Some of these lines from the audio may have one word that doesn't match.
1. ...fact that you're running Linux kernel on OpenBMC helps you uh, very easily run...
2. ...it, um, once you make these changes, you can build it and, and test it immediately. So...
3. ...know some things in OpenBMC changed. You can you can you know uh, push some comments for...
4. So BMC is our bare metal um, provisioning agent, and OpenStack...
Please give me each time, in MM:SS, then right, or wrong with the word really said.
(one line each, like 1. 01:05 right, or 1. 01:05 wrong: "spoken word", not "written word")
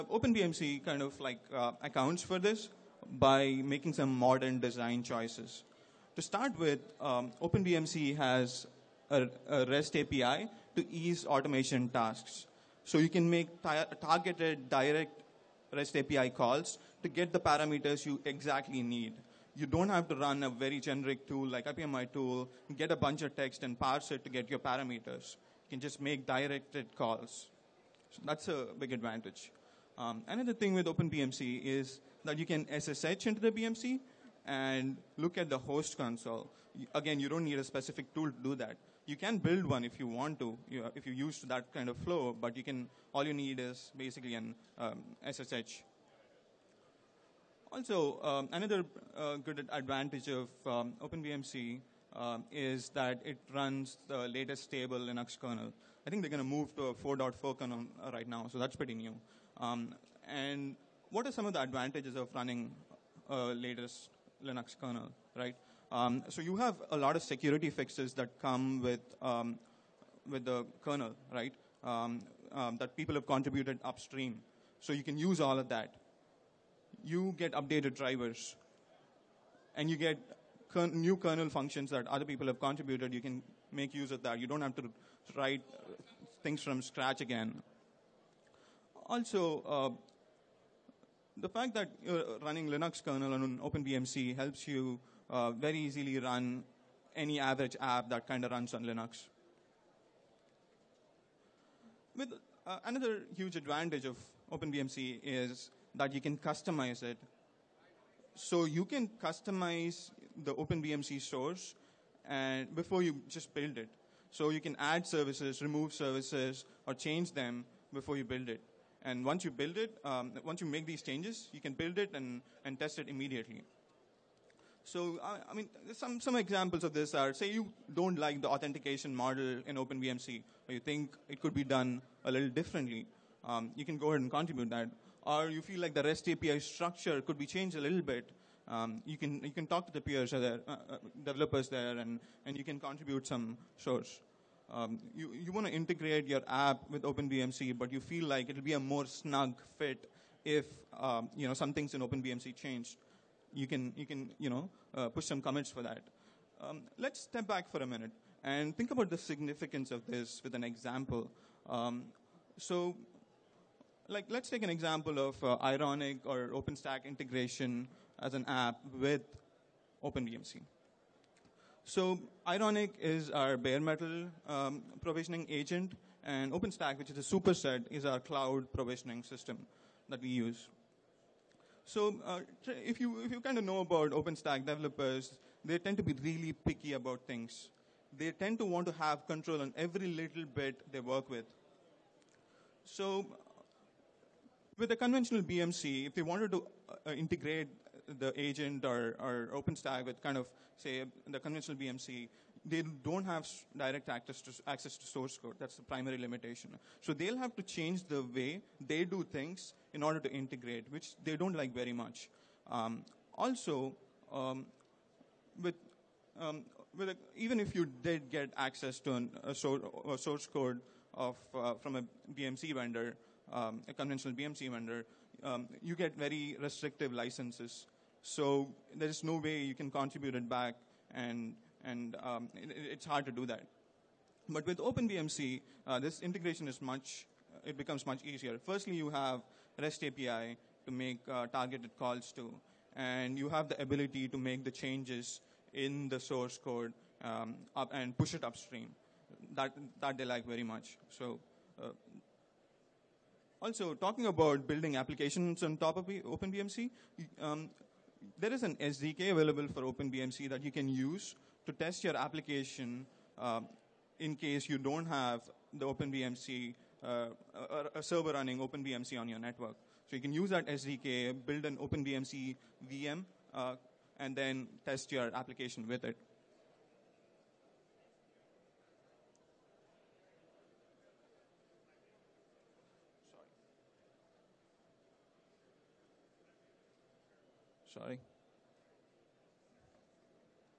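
1. 01:31 right
2. 01:59 right
3. 02:31 right
4. 02:51 wrong: "Ironic", not "BMC".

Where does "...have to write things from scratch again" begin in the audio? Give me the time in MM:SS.
01:24.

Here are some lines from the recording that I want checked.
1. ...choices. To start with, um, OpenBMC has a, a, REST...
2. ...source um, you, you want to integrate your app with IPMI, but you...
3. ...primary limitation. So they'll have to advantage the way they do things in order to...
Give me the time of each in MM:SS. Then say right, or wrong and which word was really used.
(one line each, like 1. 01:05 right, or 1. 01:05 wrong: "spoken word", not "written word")
1. 00:05 right
2. 02:23 wrong: "OpenBMC", not "IPMI"
3. 03:25 wrong: "change", not "advantage".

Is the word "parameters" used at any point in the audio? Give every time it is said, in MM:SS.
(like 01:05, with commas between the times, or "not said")
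00:17, 00:24.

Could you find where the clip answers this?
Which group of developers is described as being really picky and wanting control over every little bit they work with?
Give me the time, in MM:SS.
03:04.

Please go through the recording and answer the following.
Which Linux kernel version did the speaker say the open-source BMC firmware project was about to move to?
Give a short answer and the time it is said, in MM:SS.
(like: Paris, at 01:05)
4.4, at 00:56.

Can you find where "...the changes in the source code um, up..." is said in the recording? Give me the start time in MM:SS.
04:04.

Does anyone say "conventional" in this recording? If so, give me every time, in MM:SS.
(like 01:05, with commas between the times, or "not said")
03:14, 03:21, 03:43.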